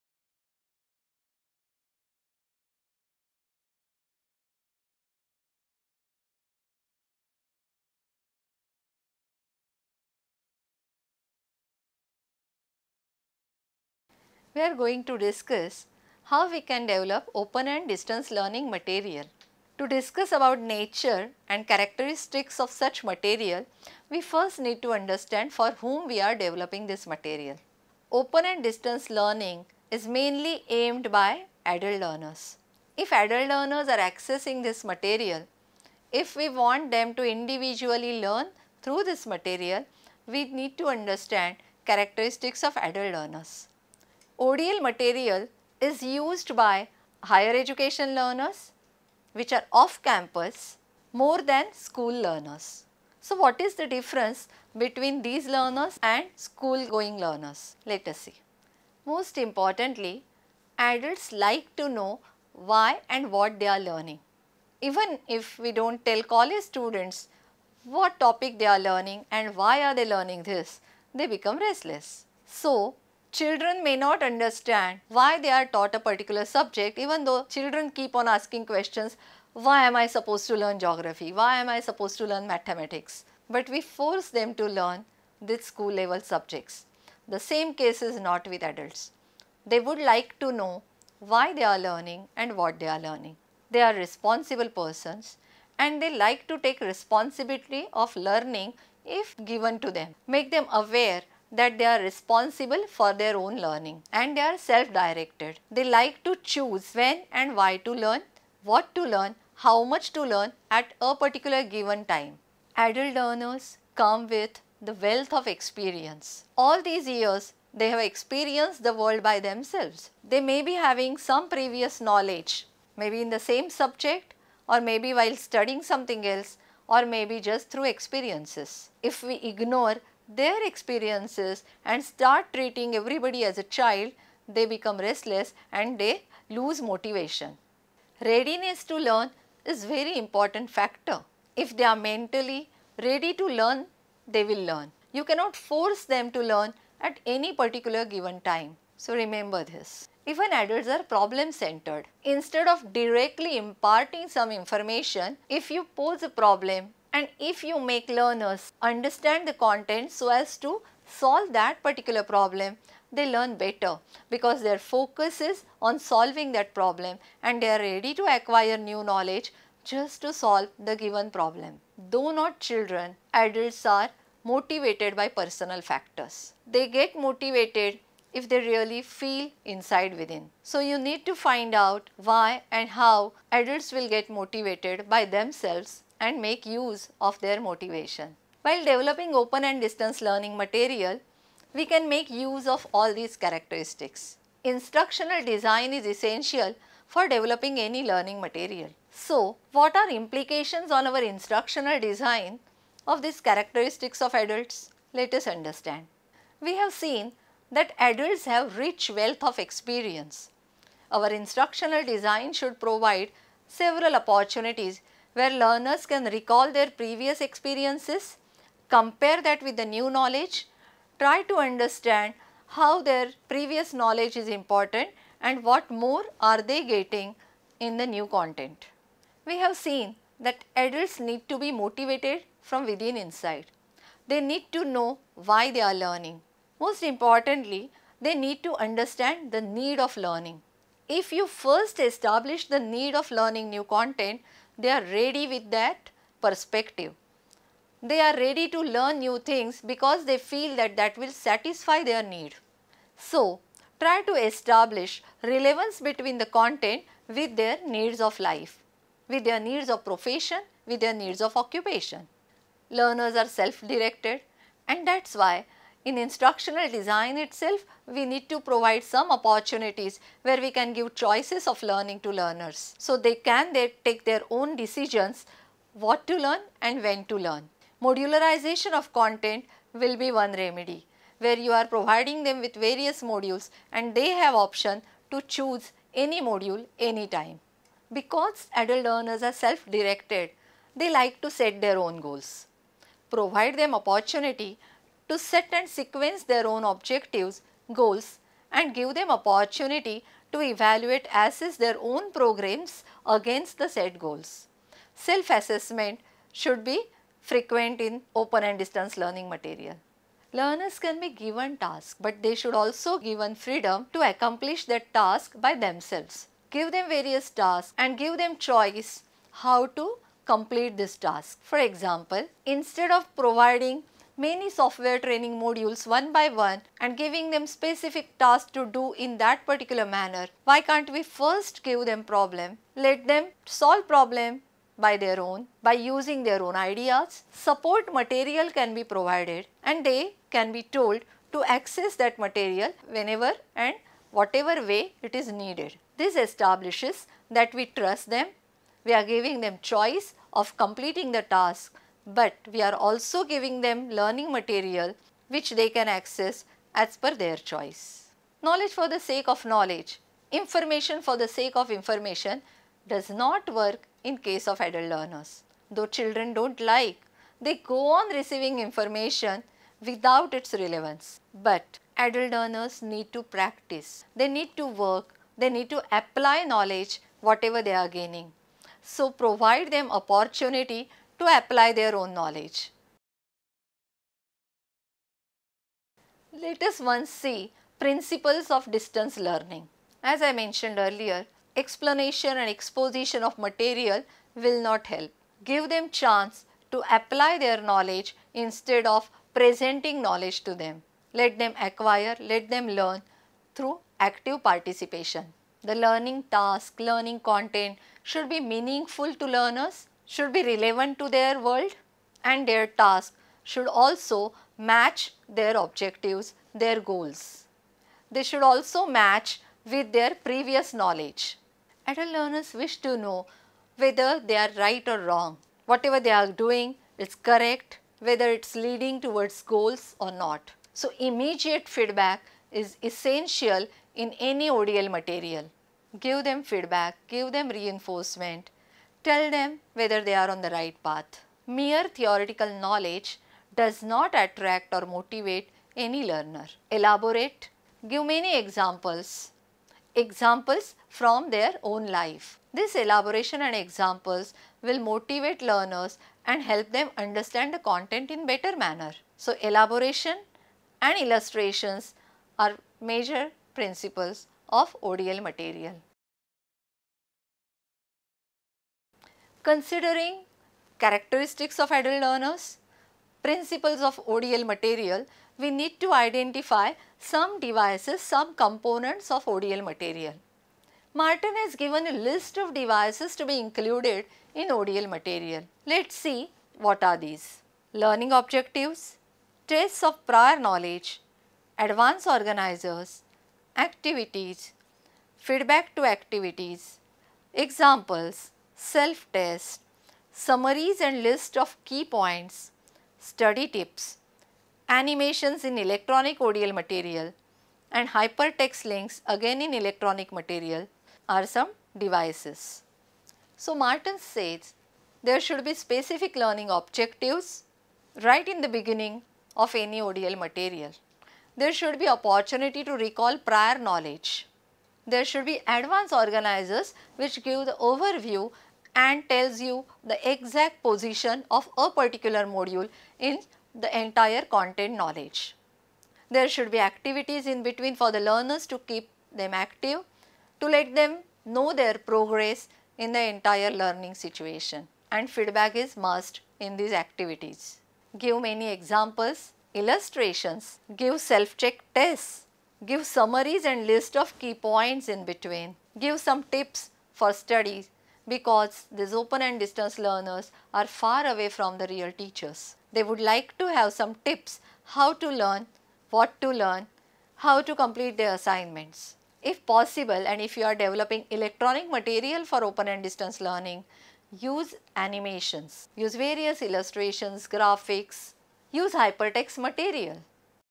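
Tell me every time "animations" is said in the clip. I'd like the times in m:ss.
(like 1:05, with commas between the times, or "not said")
8:24, 9:34.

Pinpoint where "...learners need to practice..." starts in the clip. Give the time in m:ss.
6:12.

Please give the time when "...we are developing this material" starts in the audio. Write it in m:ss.
0:26.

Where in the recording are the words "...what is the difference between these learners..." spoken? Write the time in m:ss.
0:53.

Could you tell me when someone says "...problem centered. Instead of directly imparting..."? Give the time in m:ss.
2:31.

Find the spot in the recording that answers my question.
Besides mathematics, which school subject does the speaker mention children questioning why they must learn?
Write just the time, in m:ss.
1:20.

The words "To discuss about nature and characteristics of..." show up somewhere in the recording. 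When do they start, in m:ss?
0:19.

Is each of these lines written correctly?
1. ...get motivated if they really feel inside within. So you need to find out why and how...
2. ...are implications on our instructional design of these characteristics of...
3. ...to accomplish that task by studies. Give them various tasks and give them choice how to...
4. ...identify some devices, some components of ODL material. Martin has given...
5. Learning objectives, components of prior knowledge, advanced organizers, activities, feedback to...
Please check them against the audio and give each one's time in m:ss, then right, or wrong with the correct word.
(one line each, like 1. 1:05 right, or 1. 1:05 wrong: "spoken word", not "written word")
1. 2:56 right
2. 3:19 right
3. 5:14 wrong: "themselves", not "studies"
4. 7:56 right
5. 8:07 wrong: "tests", not "components".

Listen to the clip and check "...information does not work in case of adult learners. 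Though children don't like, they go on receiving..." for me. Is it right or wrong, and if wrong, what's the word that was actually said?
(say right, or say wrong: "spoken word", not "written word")
right.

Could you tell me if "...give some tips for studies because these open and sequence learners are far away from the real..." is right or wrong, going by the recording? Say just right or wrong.
wrong.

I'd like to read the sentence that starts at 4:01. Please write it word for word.
If you first establish the need of learning new content, they are ready with that perspective.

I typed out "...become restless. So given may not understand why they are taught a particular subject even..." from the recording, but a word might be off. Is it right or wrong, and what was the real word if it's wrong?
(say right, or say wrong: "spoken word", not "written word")
wrong: "children", not "given".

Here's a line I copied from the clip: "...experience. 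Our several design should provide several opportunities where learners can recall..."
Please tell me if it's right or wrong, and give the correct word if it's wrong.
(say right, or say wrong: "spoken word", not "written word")
wrong: "instructional", not "several".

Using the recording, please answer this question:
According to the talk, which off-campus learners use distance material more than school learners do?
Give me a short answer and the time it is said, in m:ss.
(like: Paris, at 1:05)
Higher education learners, at 0:47.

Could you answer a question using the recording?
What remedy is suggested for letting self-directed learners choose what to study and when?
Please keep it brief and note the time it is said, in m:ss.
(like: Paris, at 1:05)
Modularization of content, at 4:38.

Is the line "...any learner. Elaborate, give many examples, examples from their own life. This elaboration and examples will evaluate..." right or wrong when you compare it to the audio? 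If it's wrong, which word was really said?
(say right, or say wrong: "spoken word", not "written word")
wrong: "motivate", not "evaluate".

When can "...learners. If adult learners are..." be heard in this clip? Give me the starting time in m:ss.
0:32.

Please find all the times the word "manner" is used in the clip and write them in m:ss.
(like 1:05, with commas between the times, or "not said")
5:30, 7:38.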